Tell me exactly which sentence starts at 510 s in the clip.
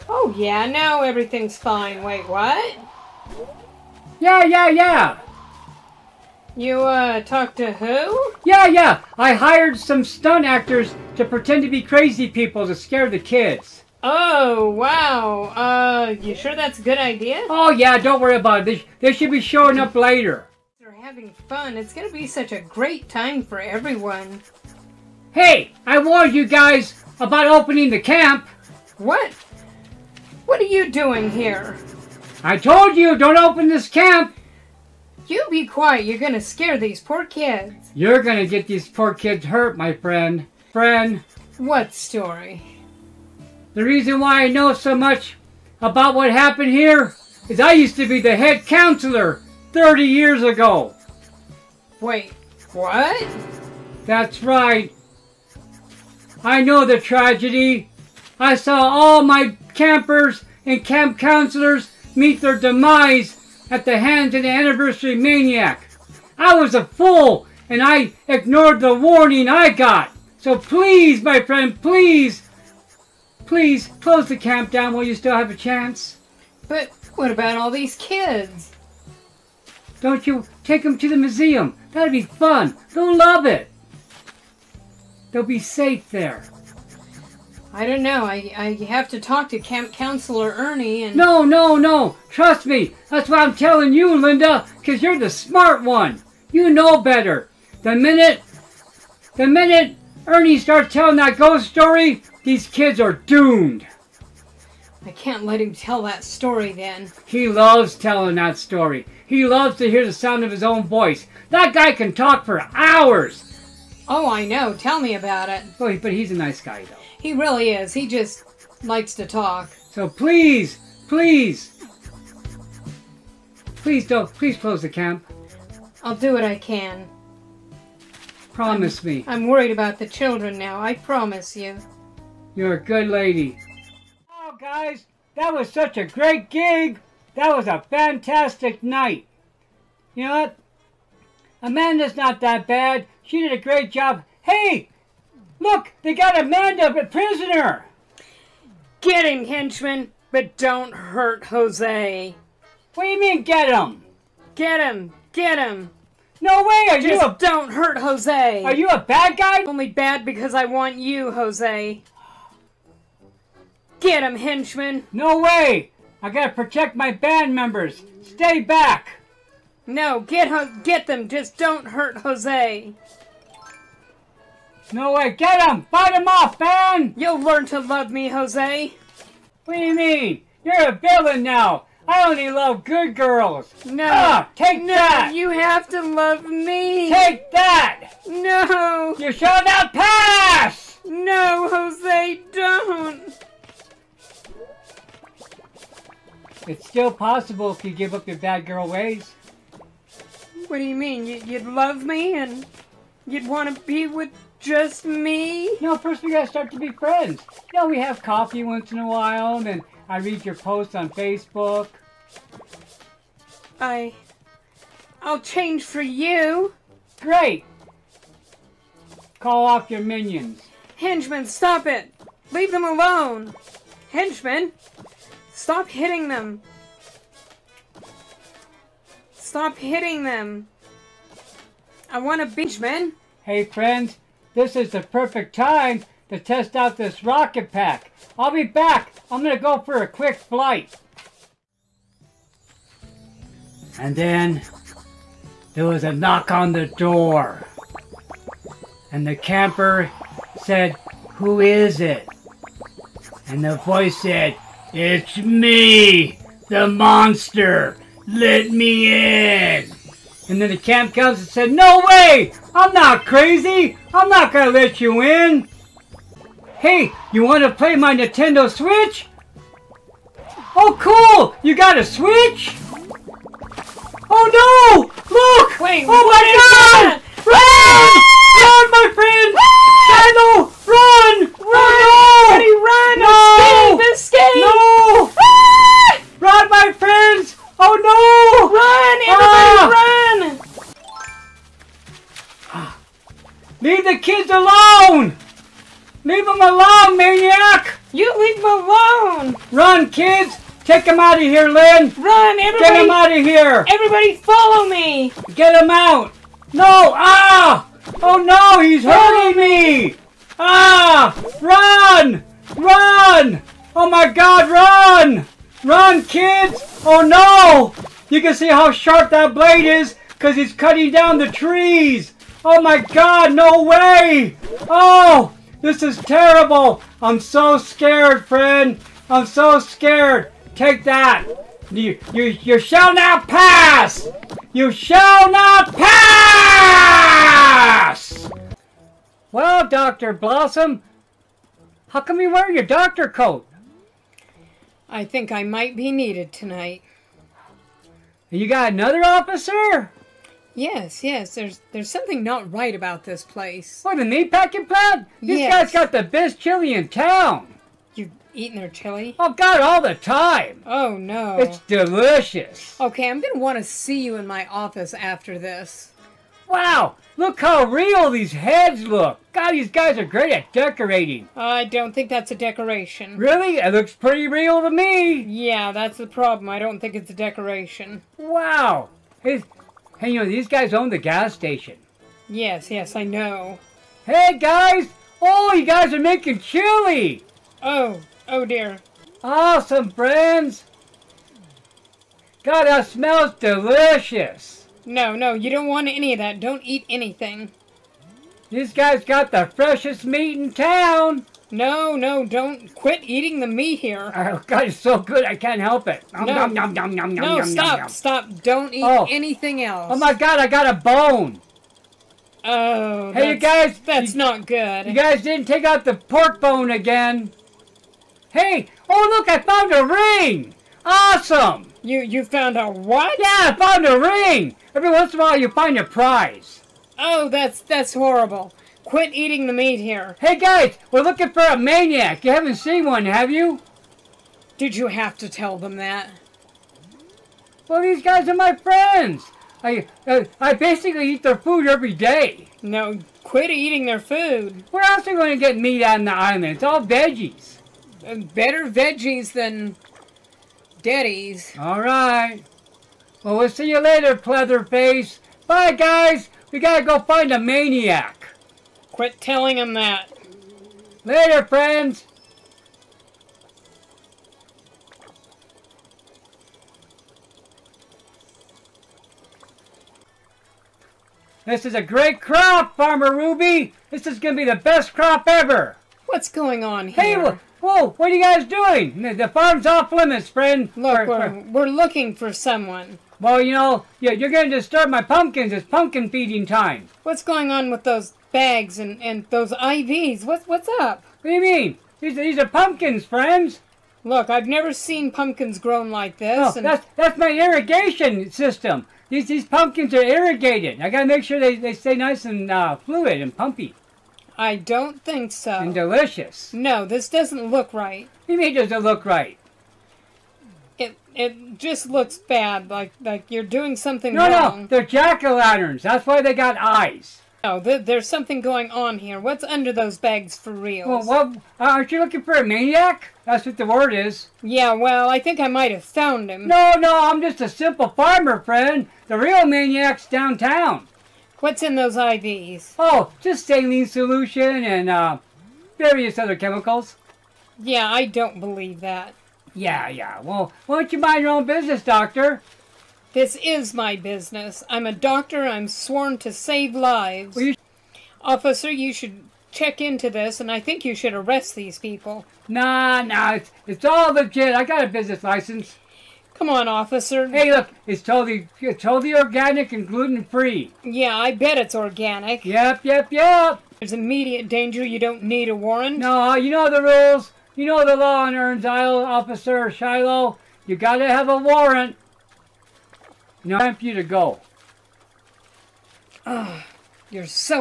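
It it just looks bad, like like you're doing something no, wrong.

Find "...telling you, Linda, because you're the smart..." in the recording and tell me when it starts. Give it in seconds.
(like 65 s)
93 s.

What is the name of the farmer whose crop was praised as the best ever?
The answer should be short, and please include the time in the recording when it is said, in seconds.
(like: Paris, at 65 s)
Ruby, at 472 s.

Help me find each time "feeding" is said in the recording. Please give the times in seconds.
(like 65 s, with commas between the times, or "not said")
486 s.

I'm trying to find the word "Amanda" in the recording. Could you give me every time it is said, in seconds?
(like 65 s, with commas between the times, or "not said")
141 s, 146 s.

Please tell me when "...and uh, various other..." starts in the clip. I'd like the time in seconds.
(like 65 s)
534 s.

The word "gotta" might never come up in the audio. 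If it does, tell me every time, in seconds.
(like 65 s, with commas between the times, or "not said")
166 s, 206 s, 456 s, 501 s, 570 s.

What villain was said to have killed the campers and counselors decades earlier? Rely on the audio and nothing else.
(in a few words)
the anniversary maniac.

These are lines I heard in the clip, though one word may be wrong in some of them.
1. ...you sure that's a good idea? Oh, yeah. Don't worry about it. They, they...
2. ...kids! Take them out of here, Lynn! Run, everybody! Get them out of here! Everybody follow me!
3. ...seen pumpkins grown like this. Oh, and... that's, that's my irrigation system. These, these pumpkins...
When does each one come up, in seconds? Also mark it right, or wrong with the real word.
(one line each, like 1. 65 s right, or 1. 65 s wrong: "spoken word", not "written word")
1. 16 s right
2. 300 s right
3. 494 s right.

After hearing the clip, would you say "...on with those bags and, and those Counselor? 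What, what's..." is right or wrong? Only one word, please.
wrong.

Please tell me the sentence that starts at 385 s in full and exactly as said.
Oh, you guys are making chili!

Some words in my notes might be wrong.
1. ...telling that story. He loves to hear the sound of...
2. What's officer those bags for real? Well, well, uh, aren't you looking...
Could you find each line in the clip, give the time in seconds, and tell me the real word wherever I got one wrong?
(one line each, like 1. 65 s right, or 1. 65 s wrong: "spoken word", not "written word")
1. 107 s right
2. 519 s wrong: "under", not "officer".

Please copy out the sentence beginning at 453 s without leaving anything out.
Well, we'll see you later, Pleatherface.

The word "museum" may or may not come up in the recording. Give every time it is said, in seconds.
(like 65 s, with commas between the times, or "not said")
81 s.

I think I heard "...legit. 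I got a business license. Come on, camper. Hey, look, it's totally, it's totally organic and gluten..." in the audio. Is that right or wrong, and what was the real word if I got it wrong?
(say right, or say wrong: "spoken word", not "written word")
wrong: "officer", not "camper".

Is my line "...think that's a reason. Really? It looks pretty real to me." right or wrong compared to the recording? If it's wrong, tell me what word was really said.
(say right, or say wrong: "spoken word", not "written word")
wrong: "decoration", not "reason".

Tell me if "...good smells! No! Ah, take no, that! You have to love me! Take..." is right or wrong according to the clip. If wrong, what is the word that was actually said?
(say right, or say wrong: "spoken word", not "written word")
wrong: "girls", not "smells".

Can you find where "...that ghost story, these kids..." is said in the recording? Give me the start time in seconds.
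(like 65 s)
101 s.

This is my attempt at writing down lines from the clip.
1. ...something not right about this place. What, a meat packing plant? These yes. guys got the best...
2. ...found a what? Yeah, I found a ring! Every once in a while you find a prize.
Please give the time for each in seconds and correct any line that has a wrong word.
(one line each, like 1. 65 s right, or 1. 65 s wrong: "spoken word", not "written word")
1. 352 s right
2. 422 s right.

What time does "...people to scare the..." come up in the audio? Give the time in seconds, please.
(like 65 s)
12 s.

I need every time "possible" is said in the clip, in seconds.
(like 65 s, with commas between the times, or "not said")
197 s.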